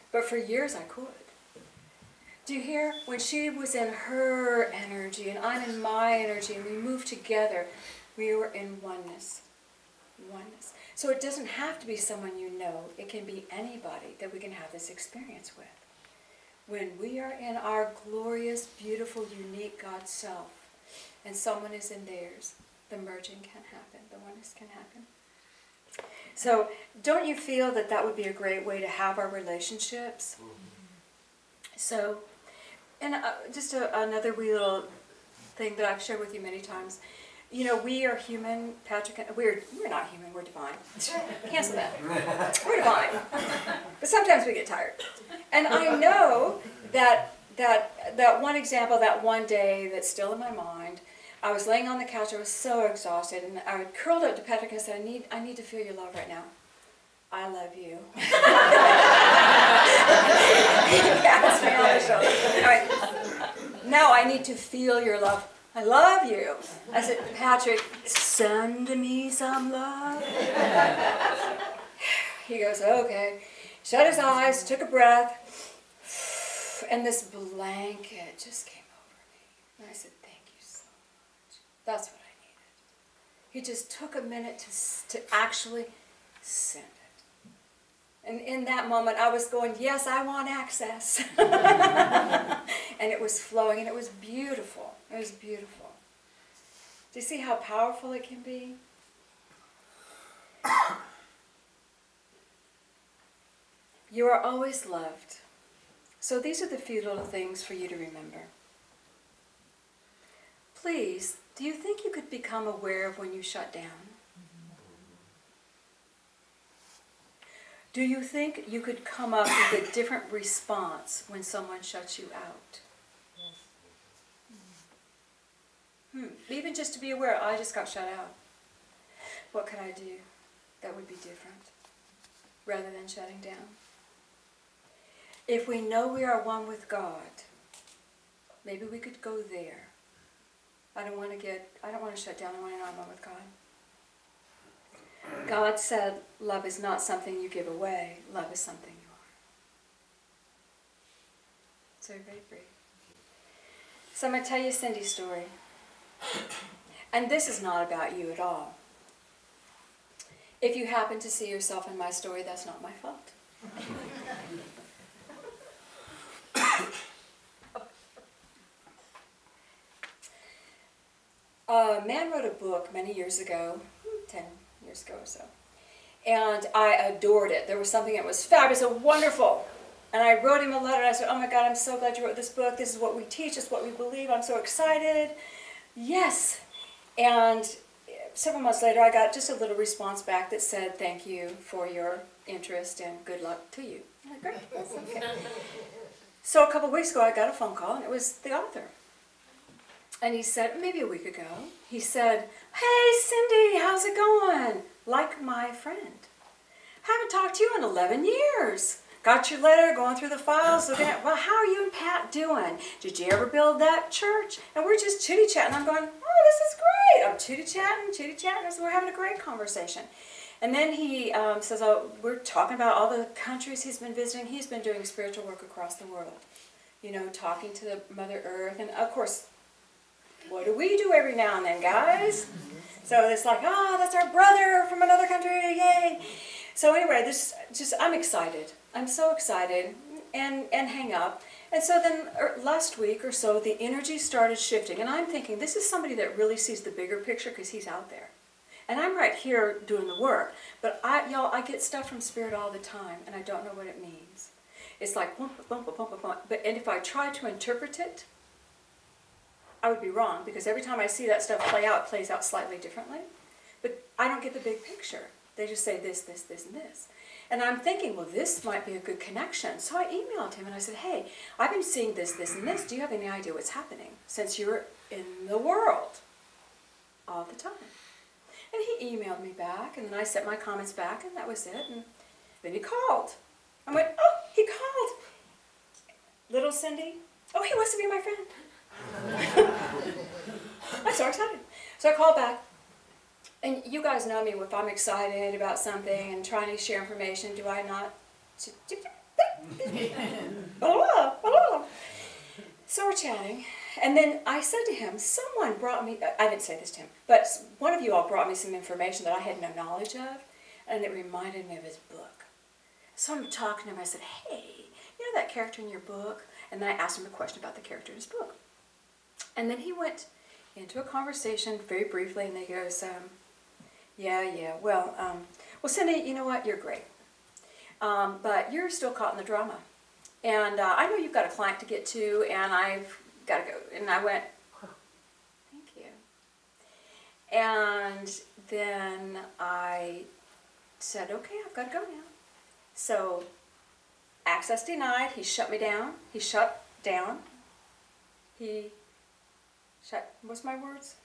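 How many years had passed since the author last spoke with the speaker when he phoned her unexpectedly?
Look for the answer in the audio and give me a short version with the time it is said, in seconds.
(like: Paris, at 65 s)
11, at 207 s.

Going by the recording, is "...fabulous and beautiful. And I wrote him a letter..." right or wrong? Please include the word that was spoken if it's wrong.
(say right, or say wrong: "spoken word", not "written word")
wrong: "wonderful", not "beautiful".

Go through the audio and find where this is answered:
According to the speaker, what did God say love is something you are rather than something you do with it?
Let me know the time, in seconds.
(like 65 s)
147 s.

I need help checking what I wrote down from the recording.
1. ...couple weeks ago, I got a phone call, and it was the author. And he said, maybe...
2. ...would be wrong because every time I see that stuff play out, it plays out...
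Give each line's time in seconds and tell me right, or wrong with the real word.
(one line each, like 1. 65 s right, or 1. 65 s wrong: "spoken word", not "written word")
1. 196 s right
2. 259 s right.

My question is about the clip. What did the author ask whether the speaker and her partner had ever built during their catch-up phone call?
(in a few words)
church.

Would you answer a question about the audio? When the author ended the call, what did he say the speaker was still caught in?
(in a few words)
the drama.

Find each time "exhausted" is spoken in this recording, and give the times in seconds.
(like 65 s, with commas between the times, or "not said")
52 s.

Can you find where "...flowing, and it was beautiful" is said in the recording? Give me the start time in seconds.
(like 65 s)
93 s.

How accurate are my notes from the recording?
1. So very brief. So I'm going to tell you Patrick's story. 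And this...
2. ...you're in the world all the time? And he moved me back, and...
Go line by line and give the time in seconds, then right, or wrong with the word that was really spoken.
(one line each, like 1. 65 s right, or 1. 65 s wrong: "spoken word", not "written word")
1. 151 s wrong: "Cindy", not "Patrick"
2. 274 s wrong: "emailed", not "moved".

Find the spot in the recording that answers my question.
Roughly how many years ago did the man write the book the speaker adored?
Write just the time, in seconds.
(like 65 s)
174 s.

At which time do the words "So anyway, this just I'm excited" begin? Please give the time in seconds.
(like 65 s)
236 s.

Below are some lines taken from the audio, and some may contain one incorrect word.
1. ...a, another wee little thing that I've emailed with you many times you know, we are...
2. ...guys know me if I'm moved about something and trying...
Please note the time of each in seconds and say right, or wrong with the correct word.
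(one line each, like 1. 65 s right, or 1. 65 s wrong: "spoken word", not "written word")
1. 33 s wrong: "shared", not "emailed"
2. 294 s wrong: "excited", not "moved".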